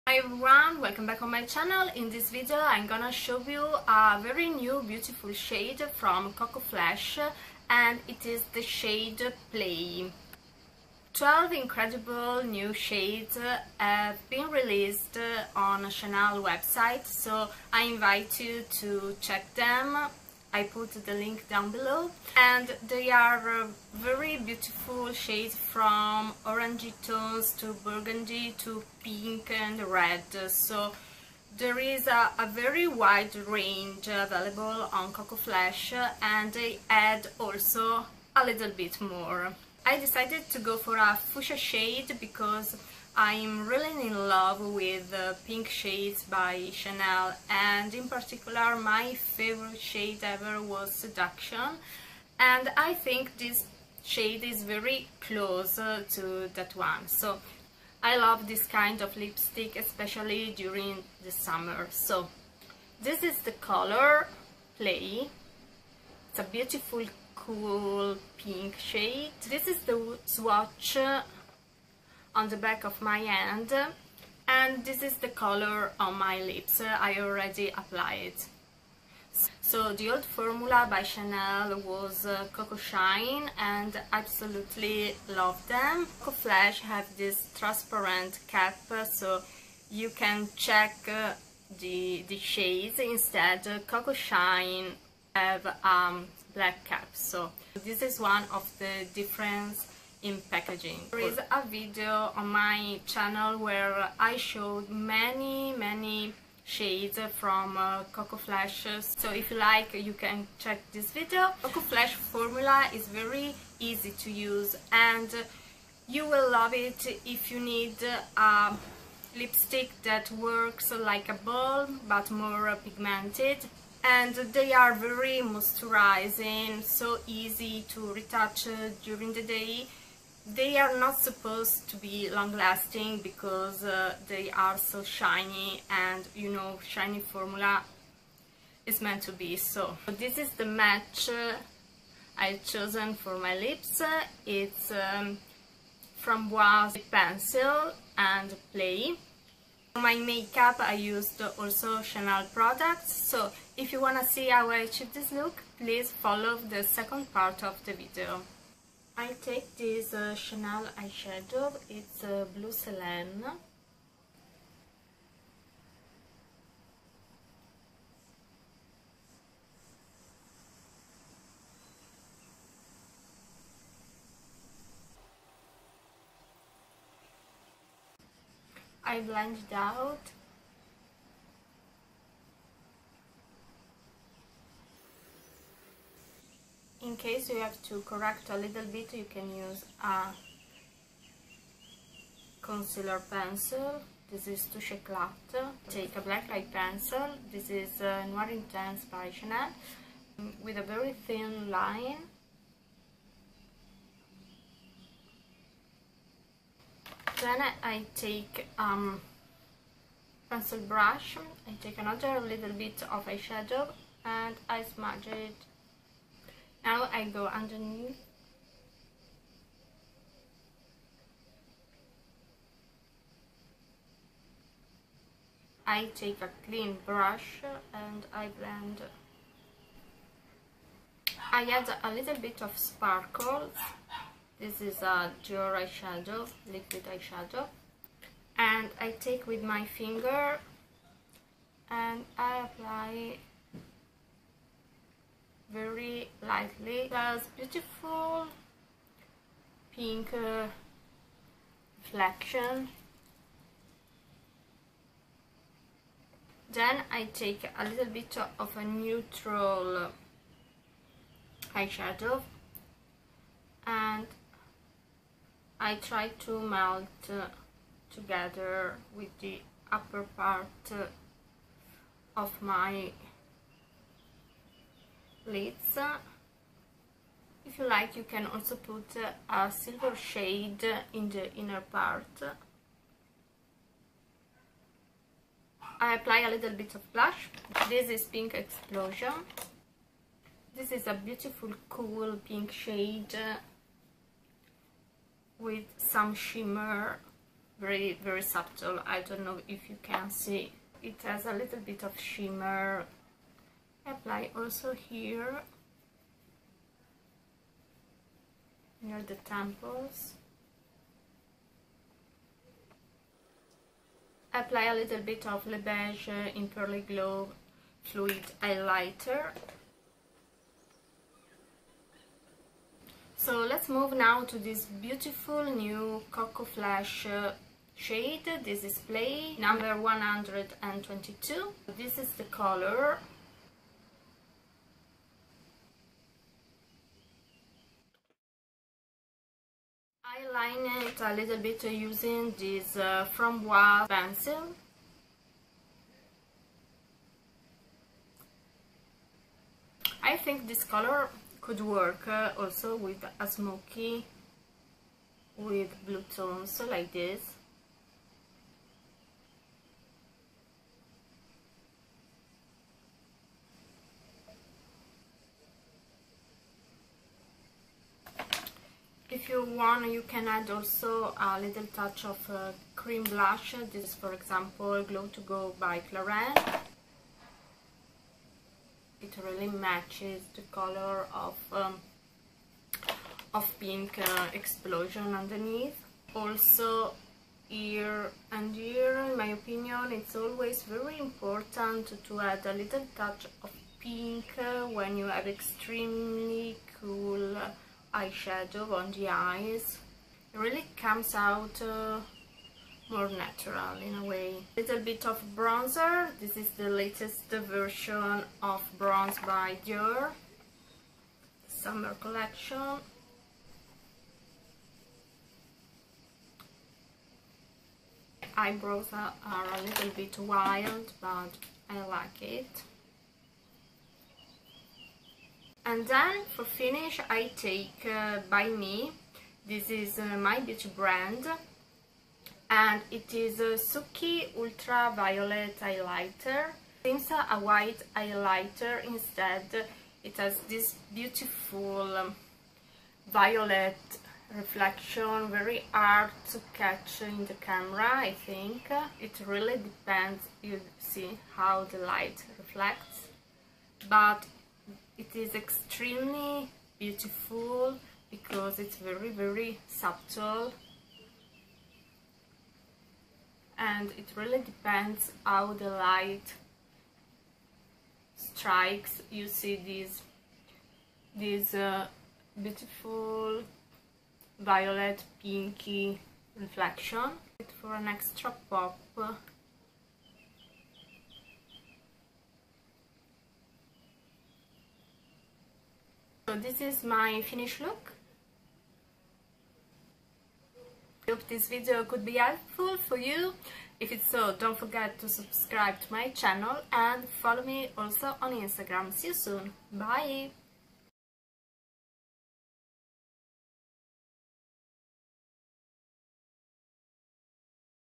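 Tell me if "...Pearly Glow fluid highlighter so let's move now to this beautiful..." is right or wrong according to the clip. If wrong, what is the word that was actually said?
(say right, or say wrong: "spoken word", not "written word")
right.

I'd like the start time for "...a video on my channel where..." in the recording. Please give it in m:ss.
1:41.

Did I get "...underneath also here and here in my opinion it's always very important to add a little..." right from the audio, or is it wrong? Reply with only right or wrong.
right.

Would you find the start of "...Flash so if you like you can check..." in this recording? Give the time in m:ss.
1:48.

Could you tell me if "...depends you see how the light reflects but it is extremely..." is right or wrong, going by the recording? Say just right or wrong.
right.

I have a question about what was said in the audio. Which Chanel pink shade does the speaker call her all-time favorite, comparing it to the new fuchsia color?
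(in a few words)
Seduction.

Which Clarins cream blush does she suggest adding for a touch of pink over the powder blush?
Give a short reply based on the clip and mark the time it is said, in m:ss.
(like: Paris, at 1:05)
Glow to Go, at 6:15.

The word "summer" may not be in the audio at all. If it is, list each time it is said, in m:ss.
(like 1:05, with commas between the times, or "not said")
1:01, 6:51.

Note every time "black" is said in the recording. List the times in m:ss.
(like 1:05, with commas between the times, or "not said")
1:36, 3:16.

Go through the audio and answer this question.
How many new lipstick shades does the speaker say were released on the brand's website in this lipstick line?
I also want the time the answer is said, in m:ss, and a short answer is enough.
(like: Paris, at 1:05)
12, at 0:11.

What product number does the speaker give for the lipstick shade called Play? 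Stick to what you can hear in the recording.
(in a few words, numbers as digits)
122.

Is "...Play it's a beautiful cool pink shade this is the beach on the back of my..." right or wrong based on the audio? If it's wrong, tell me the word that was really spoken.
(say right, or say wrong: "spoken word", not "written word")
wrong: "swatch", not "beach".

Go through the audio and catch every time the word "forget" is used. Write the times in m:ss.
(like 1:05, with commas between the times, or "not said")
8:14.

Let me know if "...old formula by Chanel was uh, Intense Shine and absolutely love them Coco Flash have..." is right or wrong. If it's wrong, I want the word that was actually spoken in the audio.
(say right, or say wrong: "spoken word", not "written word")
wrong: "Coco", not "Intense".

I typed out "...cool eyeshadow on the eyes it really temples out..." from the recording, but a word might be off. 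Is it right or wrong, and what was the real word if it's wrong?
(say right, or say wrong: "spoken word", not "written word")
wrong: "comes", not "temples".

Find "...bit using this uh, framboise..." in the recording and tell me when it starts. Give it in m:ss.
5:41.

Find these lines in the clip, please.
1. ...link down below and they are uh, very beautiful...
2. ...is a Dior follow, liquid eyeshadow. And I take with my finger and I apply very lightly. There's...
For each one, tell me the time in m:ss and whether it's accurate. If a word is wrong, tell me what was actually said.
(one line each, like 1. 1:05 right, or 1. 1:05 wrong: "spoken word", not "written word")
1. 0:21 right
2. 3:54 wrong: "eyeshadow", not "follow".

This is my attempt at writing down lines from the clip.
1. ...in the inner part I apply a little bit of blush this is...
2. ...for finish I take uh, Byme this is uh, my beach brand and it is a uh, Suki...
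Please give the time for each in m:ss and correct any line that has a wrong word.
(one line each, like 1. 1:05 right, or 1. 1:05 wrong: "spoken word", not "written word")
1. 4:41 right
2. 7:06 right.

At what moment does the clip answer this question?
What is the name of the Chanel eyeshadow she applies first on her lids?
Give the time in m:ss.
2:42.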